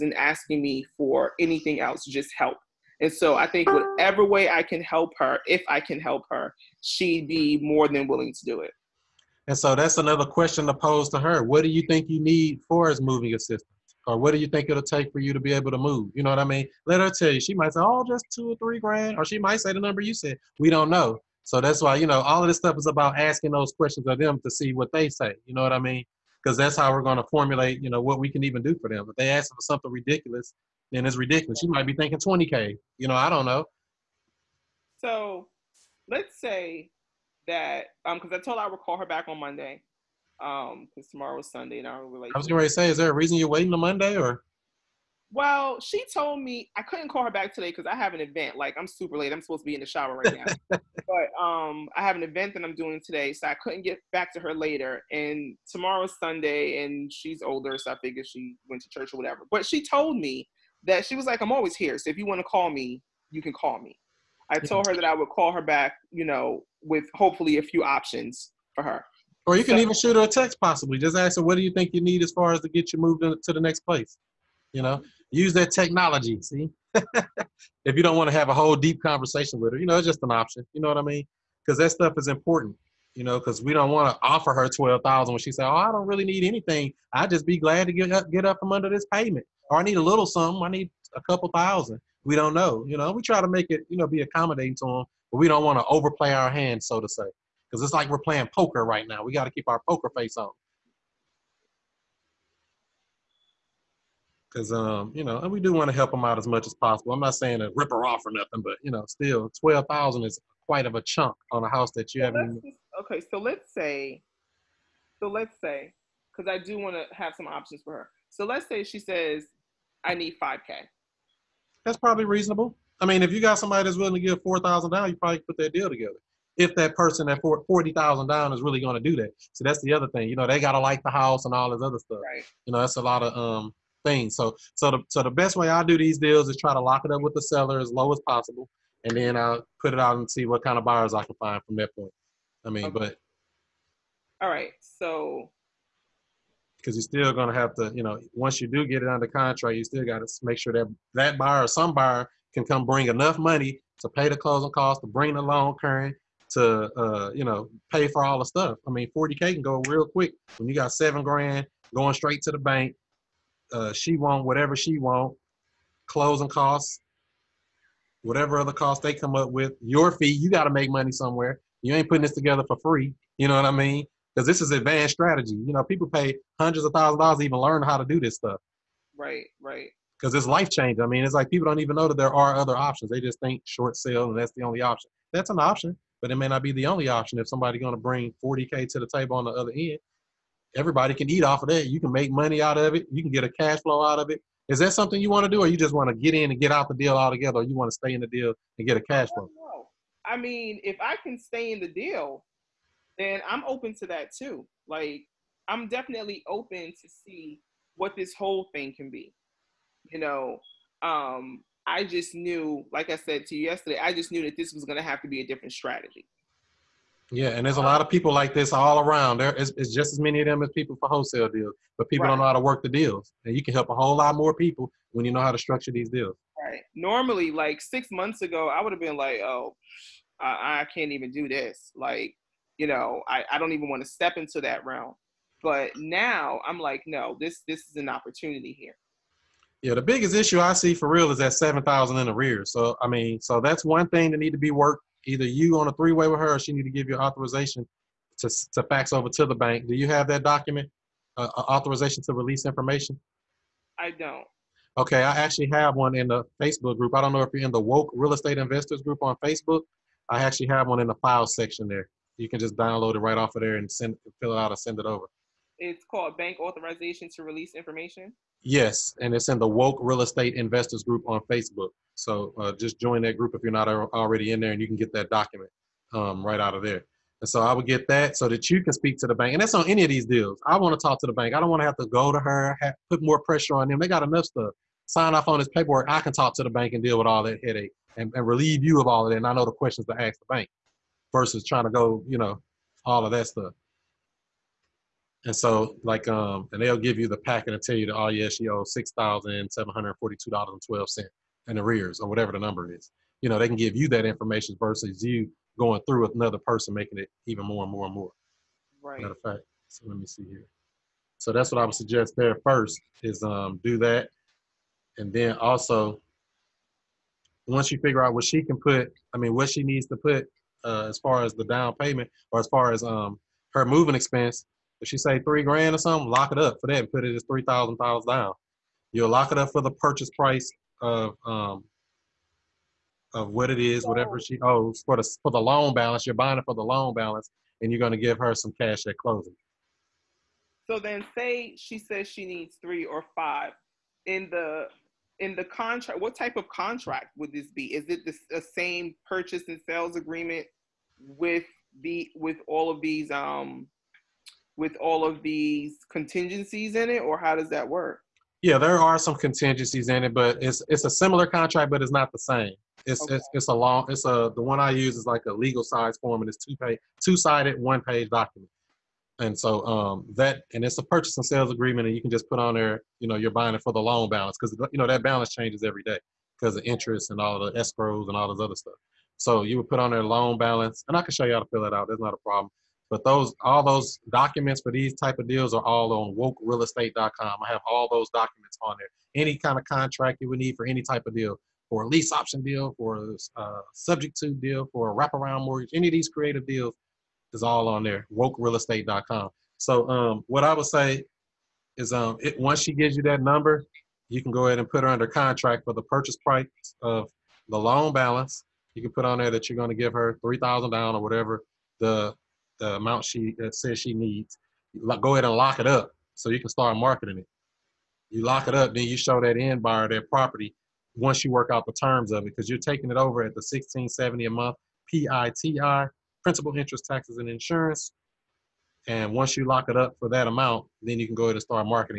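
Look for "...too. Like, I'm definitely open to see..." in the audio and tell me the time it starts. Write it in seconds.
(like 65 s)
204 s.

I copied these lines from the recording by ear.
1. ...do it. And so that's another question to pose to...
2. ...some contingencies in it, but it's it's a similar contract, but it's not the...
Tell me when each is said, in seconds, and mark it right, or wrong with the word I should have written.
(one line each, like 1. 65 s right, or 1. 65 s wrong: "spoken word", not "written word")
1. 8 s right
2. 359 s right.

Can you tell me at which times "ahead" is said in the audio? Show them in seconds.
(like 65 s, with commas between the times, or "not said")
404 s, 415 s, 431 s.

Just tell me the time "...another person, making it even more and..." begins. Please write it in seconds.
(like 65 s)
306 s.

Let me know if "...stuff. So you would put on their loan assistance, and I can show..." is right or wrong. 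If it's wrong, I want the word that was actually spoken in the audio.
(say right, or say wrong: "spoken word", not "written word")
wrong: "balance", not "assistance".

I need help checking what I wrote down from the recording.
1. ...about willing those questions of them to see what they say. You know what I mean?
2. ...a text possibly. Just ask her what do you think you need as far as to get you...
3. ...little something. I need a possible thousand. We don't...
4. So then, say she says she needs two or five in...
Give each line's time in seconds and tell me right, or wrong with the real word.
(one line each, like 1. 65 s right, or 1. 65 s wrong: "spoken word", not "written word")
1. 22 s wrong: "asking", not "willing"
2. 70 s right
3. 90 s wrong: "couple", not "possible"
4. 340 s wrong: "three", not "two".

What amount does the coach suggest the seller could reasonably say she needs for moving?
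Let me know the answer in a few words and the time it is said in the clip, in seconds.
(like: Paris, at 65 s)
5k, at 120 s.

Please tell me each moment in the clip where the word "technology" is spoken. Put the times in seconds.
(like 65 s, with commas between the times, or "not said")
75 s.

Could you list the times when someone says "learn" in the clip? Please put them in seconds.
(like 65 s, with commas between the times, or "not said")
177 s.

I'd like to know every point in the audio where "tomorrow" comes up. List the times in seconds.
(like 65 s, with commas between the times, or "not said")
41 s, 55 s.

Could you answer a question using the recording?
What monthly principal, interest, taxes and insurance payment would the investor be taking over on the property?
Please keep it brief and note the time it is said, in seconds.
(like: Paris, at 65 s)
1670, at 423 s.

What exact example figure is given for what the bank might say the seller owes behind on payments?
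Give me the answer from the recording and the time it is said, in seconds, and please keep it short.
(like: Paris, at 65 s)
$6,742.12, at 298 s.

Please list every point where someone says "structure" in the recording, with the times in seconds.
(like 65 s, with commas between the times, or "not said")
225 s.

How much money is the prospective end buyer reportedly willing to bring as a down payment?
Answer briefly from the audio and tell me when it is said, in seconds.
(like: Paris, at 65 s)
40,000, at 127 s.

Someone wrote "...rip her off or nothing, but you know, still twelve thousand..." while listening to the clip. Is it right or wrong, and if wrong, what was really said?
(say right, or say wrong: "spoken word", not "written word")
right.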